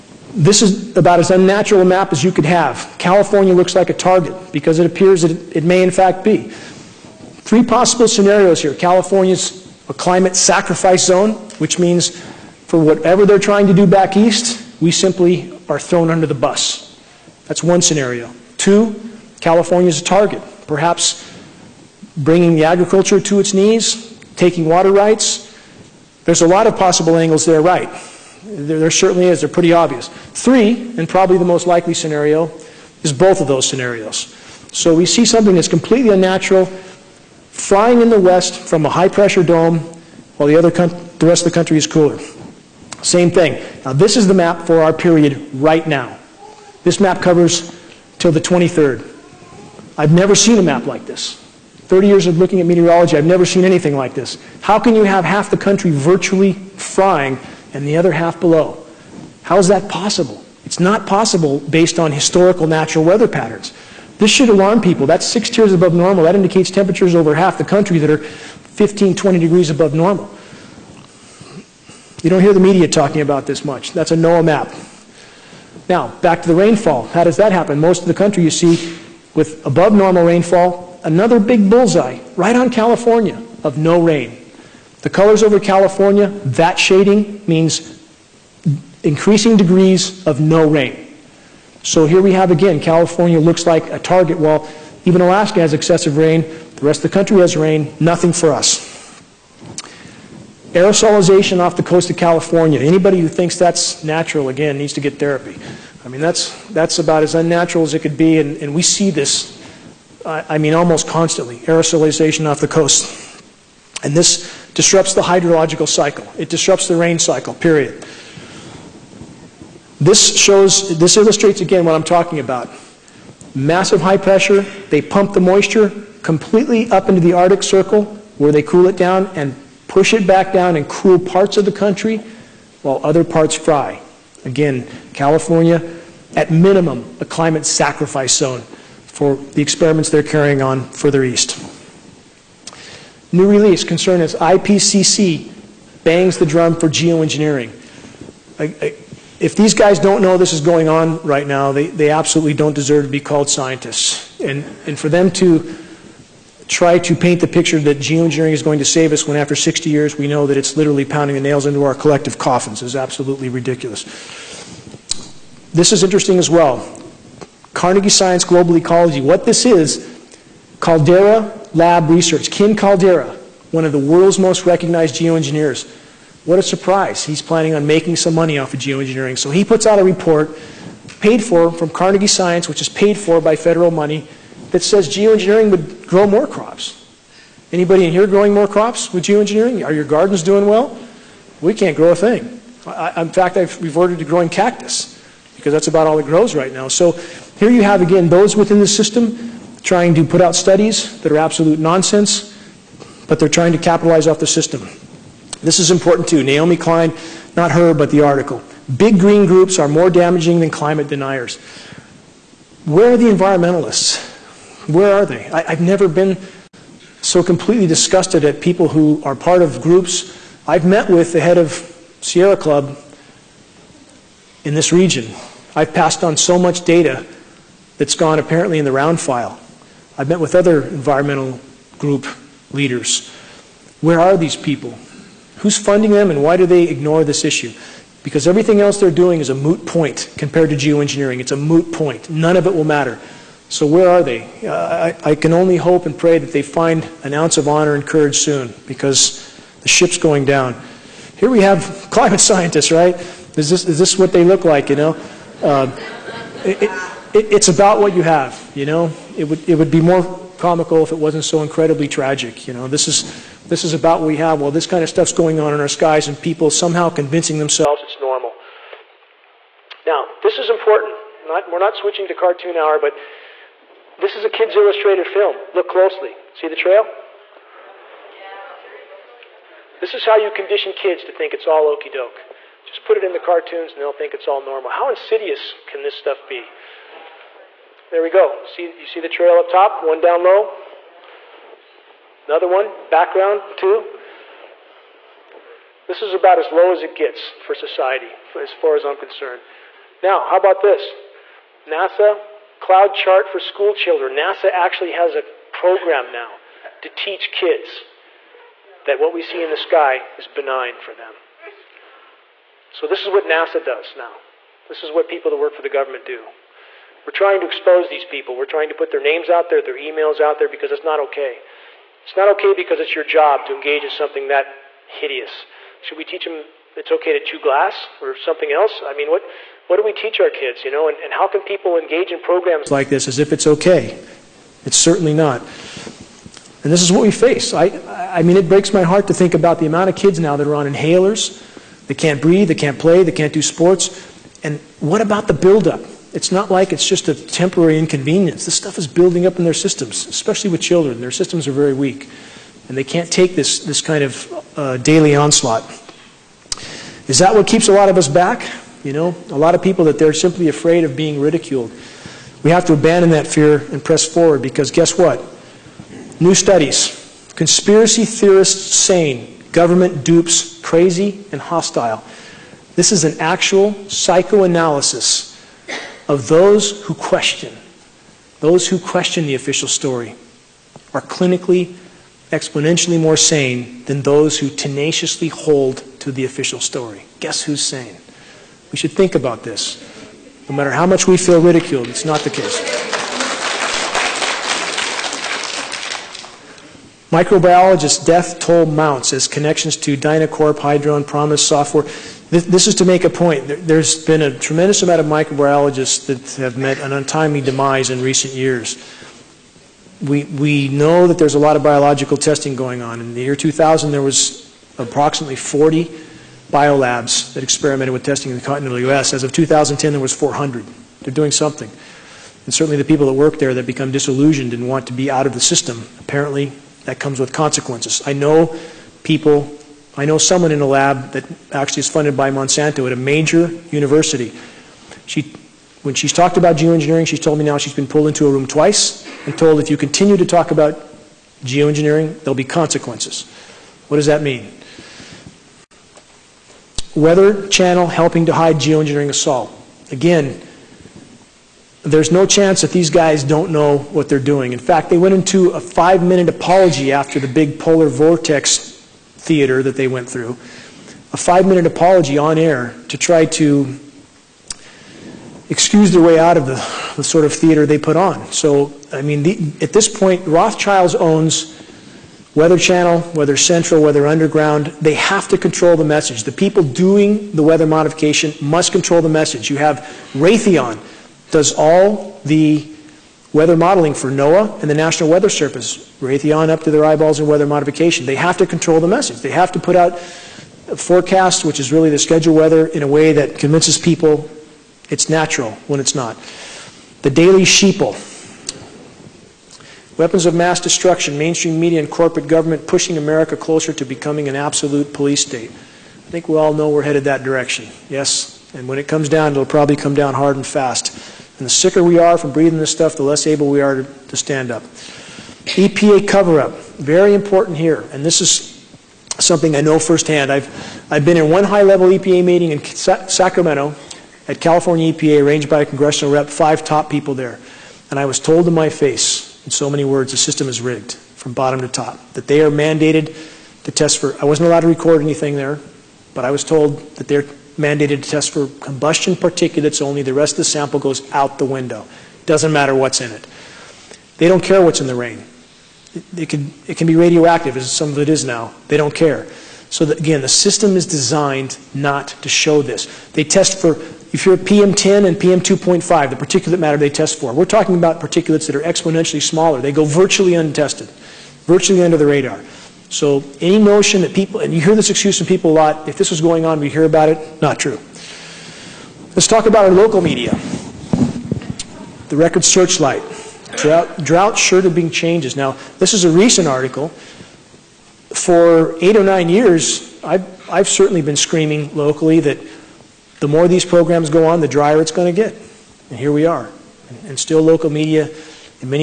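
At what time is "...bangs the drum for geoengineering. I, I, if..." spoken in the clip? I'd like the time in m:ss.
2:26.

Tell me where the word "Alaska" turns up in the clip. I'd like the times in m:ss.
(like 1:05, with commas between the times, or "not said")
1:35.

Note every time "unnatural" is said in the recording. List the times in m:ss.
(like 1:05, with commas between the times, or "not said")
0:01, 0:36, 1:47.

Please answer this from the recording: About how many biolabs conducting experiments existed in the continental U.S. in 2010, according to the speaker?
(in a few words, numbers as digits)
400.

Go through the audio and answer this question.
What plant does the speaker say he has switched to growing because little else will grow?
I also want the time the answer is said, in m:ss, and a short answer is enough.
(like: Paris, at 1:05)
Cactus, at 3:14.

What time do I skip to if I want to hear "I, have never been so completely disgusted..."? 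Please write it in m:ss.
3:35.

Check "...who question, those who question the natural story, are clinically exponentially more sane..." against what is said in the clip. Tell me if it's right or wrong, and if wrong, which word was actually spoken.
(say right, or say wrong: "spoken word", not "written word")
wrong: "official", not "natural".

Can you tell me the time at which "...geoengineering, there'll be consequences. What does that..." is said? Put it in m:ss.
7:21.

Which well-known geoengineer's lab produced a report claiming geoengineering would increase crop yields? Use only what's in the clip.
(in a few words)
Ken Caldeira.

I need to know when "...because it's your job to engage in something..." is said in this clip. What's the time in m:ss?
5:22.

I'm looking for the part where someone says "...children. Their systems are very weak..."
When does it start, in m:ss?
5:50.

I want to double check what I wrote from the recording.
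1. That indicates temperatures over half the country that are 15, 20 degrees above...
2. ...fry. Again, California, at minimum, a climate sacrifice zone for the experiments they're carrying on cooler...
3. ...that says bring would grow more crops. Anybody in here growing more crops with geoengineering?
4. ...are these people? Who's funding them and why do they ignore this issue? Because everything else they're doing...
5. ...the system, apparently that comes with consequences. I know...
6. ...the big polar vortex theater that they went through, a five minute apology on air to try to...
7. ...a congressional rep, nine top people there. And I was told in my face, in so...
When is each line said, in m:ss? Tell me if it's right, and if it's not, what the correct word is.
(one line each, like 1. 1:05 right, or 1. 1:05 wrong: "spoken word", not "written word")
1. 1:06 right
2. 2:13 wrong: "further", not "cooler"
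3. 3:04 wrong: "geoengineering", not "bring"
4. 3:54 right
5. 7:05 right
6. 7:37 right
7. 8:45 wrong: "five", not "nine".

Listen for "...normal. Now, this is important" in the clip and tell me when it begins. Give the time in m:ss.
4:28.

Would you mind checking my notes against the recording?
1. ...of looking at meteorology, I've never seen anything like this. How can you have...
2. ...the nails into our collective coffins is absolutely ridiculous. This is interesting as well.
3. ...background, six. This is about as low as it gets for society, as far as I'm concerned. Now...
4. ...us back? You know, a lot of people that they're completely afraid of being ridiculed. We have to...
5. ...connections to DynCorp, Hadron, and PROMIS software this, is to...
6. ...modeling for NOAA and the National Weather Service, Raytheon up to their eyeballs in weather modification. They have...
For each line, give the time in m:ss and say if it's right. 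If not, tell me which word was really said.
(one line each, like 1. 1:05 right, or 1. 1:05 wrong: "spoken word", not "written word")
1. 0:52 right
2. 2:41 right
3. 4:53 wrong: "two", not "six"
4. 5:58 wrong: "simply", not "completely"
5. 6:39 right
6. 8:03 right.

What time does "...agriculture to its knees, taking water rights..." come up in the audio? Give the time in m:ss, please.
0:22.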